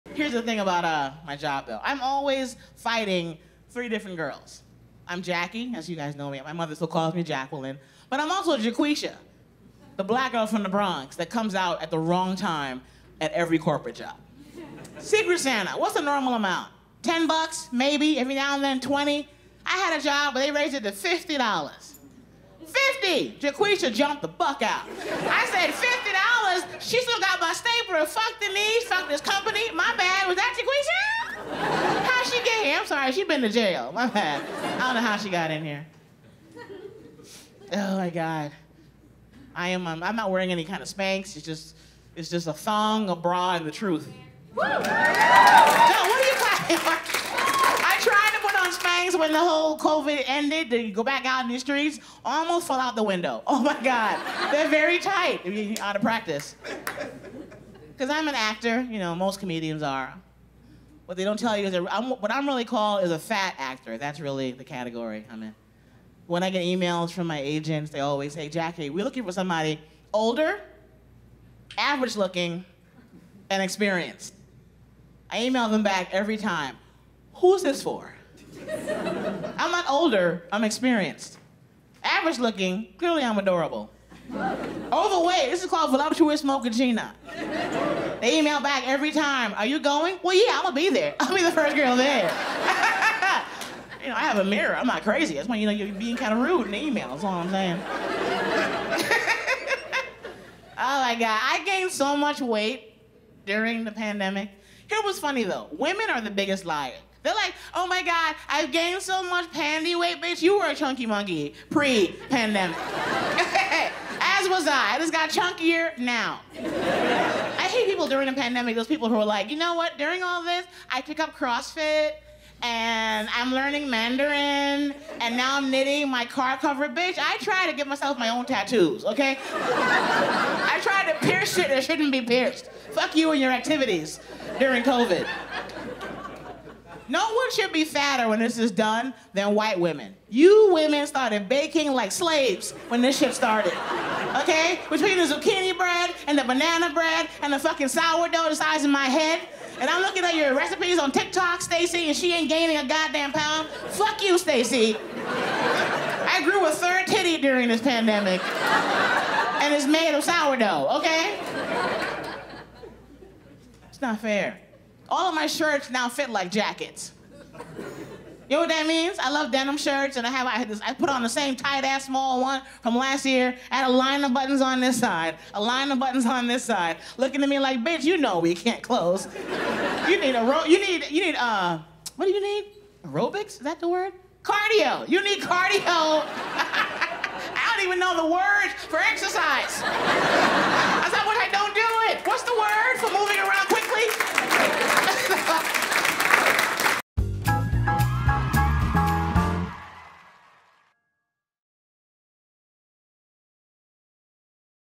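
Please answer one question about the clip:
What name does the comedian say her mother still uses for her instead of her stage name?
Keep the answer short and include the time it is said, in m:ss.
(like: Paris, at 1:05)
Jacqueline, at 0:07.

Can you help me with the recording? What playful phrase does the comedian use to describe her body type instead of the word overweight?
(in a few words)
voluptuous mochaccino.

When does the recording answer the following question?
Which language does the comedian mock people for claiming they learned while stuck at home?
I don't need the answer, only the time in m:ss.
2:03.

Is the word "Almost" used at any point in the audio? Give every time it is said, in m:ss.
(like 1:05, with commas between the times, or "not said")
0:52.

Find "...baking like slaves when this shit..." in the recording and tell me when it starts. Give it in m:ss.
2:21.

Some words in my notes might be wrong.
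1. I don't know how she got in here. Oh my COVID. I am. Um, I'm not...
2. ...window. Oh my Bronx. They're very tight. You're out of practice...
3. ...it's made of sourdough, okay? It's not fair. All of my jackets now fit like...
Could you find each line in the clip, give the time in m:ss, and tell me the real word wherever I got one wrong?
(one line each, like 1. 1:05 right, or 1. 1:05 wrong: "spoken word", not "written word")
1. 0:34 wrong: "God", not "COVID"
2. 0:53 wrong: "God", not "Bronx"
3. 2:39 wrong: "shirts", not "jackets".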